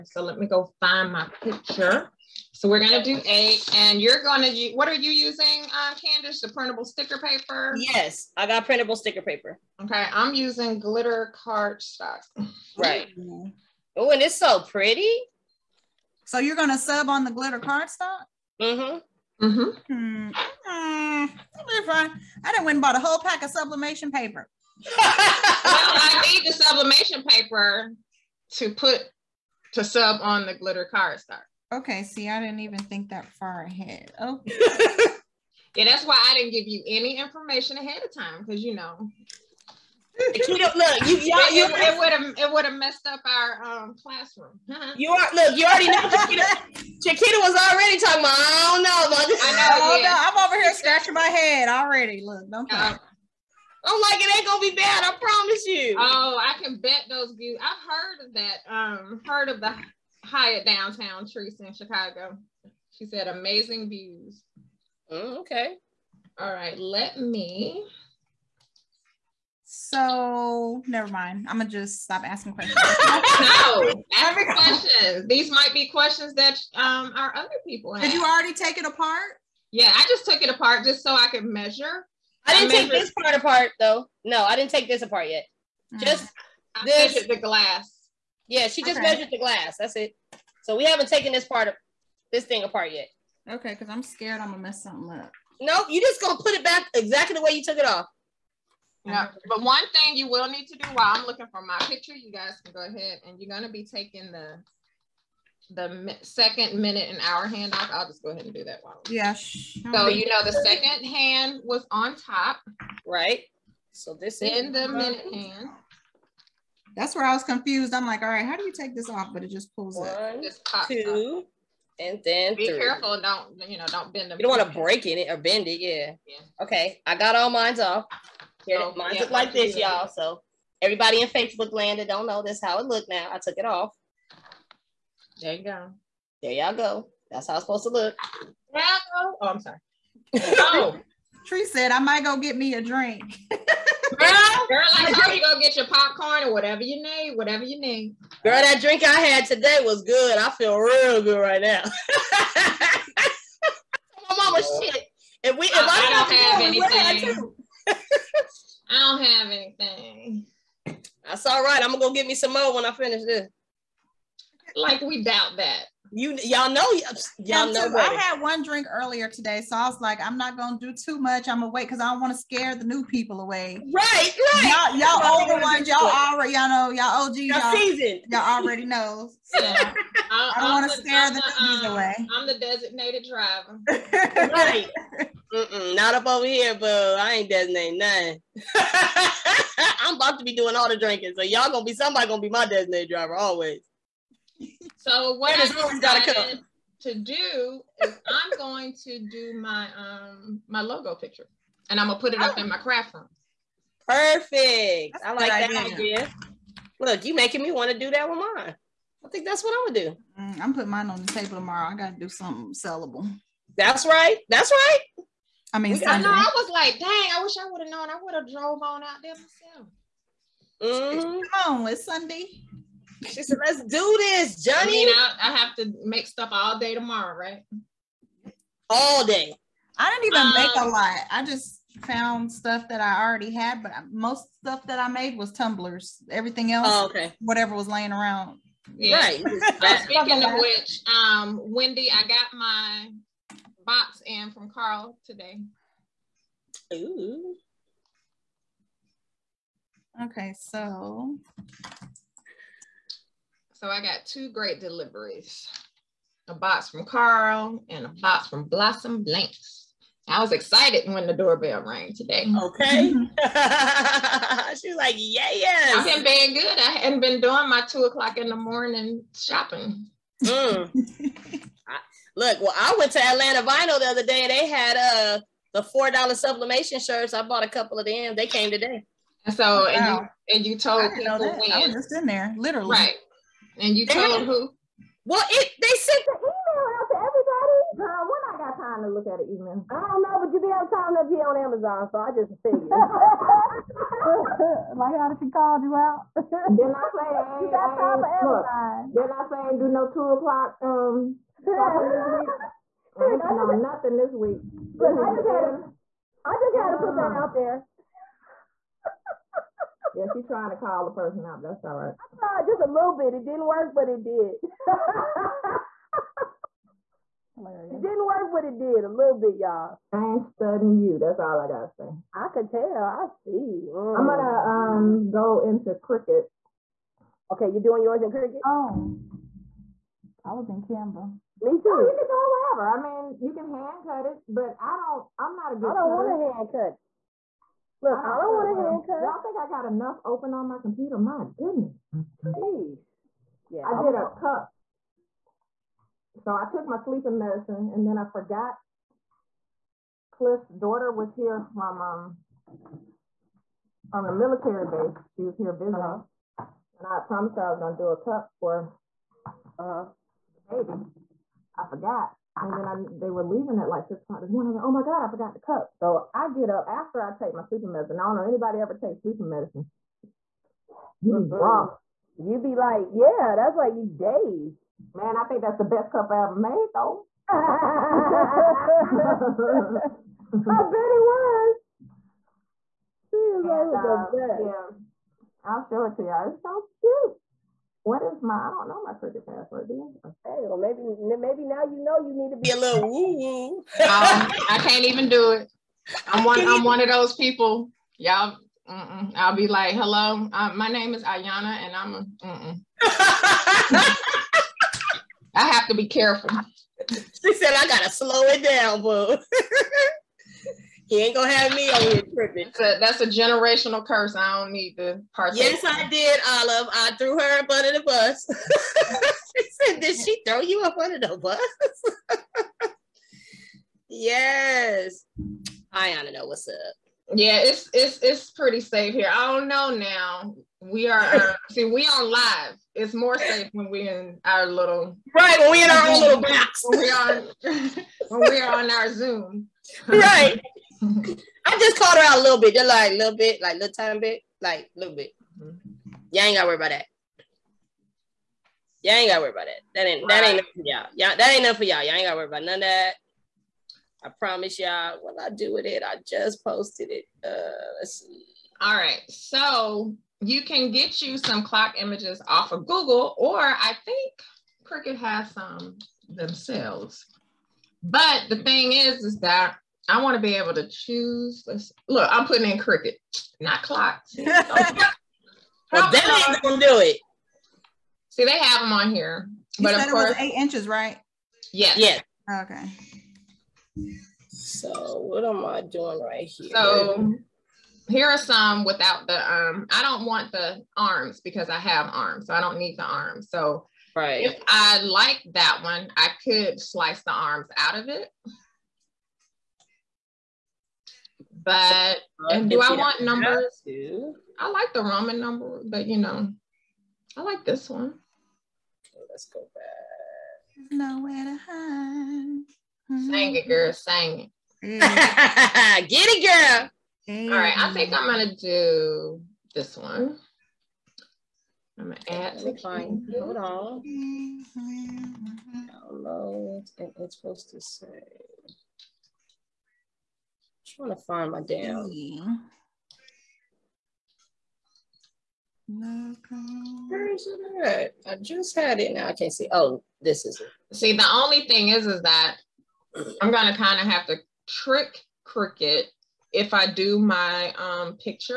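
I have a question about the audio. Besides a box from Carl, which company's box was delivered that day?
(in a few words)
Blossom Blanks.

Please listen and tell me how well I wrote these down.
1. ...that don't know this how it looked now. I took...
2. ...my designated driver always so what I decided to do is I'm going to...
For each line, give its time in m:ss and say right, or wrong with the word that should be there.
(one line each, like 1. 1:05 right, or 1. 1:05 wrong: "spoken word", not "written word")
1. 2:11 right
2. 3:12 right.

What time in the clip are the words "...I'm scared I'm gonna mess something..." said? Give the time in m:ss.
1:33.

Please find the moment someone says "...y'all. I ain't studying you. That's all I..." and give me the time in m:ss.
5:19.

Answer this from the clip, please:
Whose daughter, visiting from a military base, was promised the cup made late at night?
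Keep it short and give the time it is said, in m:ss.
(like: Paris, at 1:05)
Cliff's, at 5:50.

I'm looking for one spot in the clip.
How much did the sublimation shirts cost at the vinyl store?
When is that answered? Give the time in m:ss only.
4:35.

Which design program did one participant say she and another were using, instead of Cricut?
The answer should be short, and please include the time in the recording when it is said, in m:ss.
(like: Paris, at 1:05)
Canva, at 5:30.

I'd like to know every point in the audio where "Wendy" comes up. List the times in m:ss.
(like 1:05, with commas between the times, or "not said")
4:01.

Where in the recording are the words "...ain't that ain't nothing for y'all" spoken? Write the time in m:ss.
7:30.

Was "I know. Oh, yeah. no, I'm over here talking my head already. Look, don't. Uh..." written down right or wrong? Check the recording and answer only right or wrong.
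wrong.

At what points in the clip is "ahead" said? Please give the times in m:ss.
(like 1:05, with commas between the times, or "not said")
0:33, 0:37, 1:42, 1:48.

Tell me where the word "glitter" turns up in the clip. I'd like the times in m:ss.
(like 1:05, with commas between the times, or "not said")
0:10, 0:17, 0:30.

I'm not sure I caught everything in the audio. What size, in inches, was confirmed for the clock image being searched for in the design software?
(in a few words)
8 inches.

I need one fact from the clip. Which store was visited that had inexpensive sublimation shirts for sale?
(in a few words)
Atlanta Vinyl.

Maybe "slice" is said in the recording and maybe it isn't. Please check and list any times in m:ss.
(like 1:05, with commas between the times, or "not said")
8:16.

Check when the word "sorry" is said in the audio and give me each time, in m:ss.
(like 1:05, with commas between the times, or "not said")
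2:19.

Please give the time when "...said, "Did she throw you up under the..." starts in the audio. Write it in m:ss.
6:59.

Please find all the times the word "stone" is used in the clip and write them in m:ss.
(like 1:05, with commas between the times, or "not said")
not said.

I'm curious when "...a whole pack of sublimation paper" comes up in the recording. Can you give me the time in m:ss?
0:22.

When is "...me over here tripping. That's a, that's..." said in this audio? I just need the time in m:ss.
6:51.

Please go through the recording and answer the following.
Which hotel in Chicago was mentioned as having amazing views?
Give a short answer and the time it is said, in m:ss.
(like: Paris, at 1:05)
Hyatt, at 1:00.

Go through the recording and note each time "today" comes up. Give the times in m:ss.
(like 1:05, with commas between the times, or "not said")
2:29, 2:49, 4:05, 4:22, 4:38.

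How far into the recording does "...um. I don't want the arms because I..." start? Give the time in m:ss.
8:09.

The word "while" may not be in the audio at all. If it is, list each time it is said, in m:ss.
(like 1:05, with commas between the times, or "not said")
1:40, 1:48.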